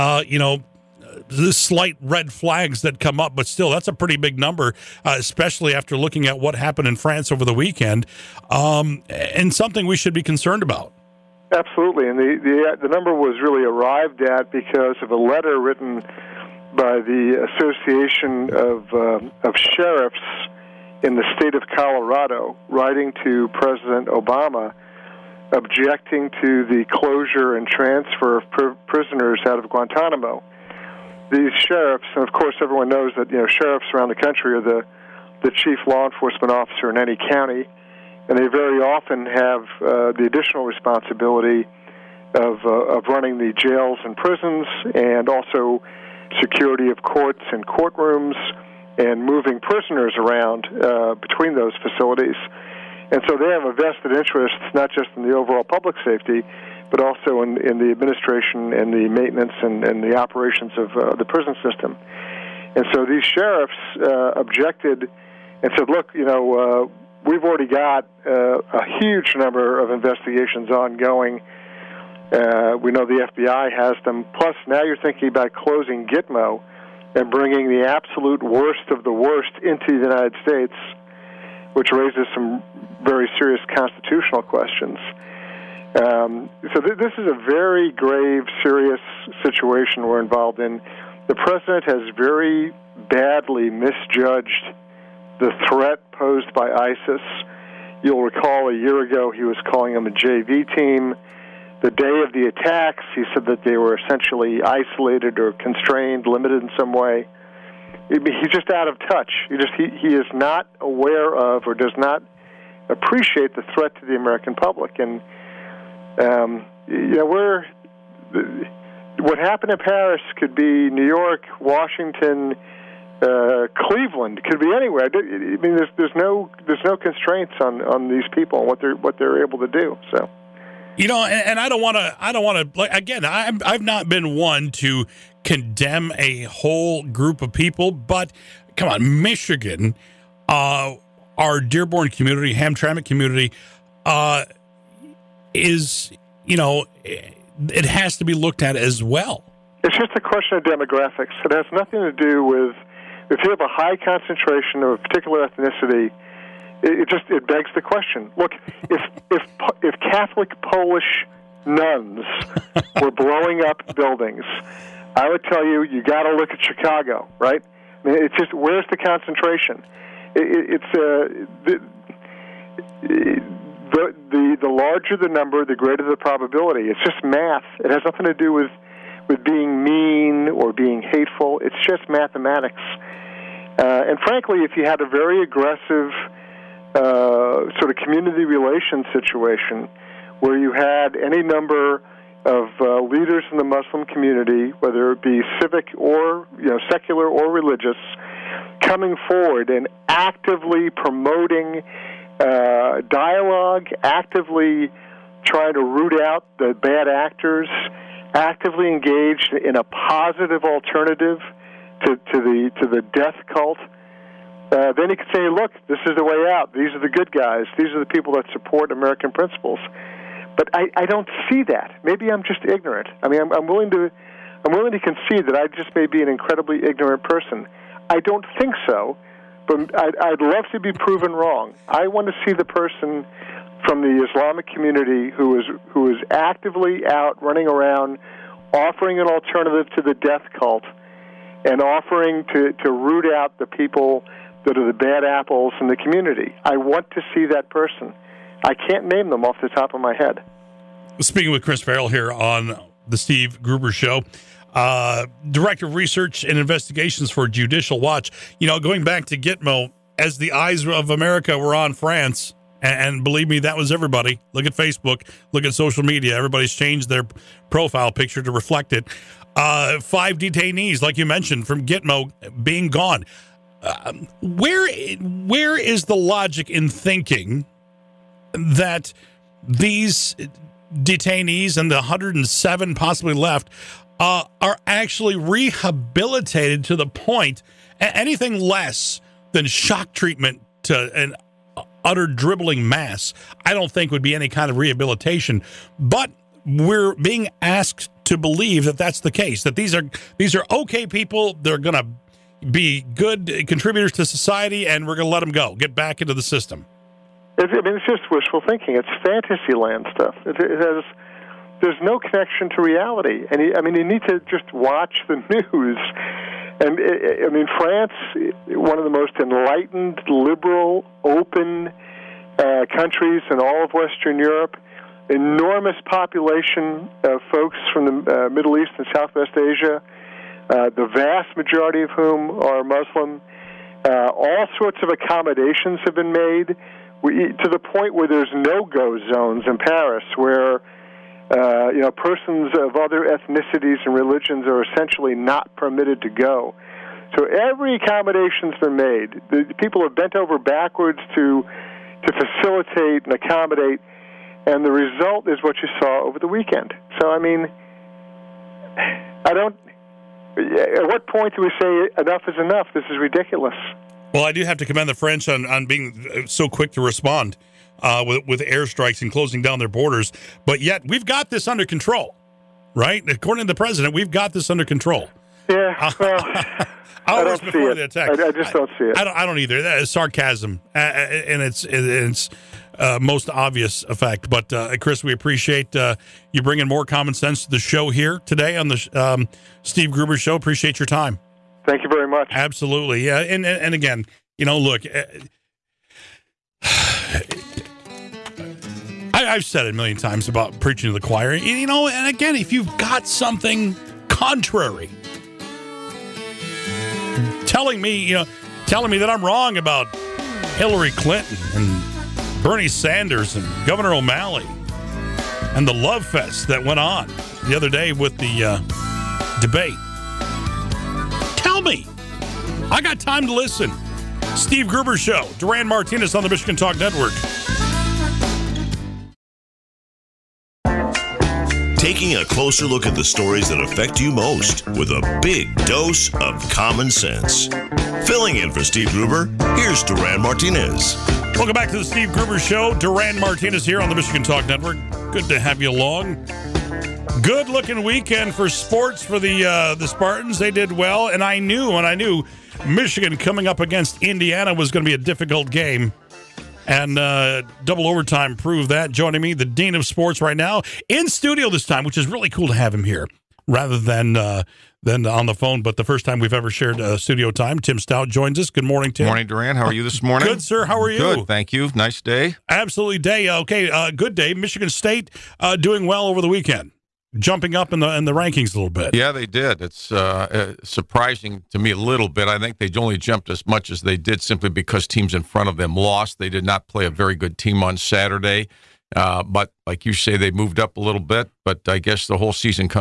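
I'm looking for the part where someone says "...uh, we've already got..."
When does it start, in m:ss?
1:06.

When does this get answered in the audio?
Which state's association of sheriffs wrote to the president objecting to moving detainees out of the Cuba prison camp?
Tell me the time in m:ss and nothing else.
0:21.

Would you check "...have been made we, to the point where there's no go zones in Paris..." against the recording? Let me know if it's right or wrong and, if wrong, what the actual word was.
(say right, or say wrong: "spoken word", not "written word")
right.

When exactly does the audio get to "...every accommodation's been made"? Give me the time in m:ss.
5:47.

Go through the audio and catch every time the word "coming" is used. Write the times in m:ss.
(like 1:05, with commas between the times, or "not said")
3:18, 7:33.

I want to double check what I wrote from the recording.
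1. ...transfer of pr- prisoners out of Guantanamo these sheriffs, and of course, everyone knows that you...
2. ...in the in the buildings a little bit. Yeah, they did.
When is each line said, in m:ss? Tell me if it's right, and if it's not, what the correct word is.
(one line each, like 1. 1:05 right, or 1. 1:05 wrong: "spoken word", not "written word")
1. 0:27 right
2. 7:57 wrong: "rankings", not "buildings".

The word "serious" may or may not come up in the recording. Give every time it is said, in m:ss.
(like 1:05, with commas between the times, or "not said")
1:23, 1:28.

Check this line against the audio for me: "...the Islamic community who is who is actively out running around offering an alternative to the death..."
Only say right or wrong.
right.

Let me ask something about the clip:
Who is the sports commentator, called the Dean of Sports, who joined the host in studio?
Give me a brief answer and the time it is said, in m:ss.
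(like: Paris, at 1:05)
Tim Staudt, at 7:47.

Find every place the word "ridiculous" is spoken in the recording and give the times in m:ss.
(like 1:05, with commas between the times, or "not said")
6:03.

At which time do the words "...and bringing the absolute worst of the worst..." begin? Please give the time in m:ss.
1:17.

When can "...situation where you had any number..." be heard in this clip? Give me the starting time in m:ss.
3:09.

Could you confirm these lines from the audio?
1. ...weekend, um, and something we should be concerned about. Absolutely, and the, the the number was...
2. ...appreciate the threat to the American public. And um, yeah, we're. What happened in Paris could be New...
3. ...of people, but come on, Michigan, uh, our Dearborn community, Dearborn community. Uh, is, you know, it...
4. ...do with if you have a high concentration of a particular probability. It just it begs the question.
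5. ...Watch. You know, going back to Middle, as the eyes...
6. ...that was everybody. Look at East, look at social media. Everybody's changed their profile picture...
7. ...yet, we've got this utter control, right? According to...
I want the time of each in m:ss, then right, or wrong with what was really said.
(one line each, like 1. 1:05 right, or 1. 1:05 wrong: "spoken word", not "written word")
1. 0:07 right
2. 1:52 right
3. 2:17 wrong: "Hamtramck", not "Dearborn"
4. 2:32 wrong: "ethnicity", not "probability"
5. 4:17 wrong: "Gitmo", not "Middle"
6. 4:23 wrong: "Facebook", not "East"
7. 6:10 wrong: "under", not "utter".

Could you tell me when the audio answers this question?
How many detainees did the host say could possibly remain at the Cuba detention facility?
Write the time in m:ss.
4:41.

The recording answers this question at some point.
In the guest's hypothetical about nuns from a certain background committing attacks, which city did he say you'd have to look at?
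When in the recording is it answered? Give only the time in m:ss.
2:46.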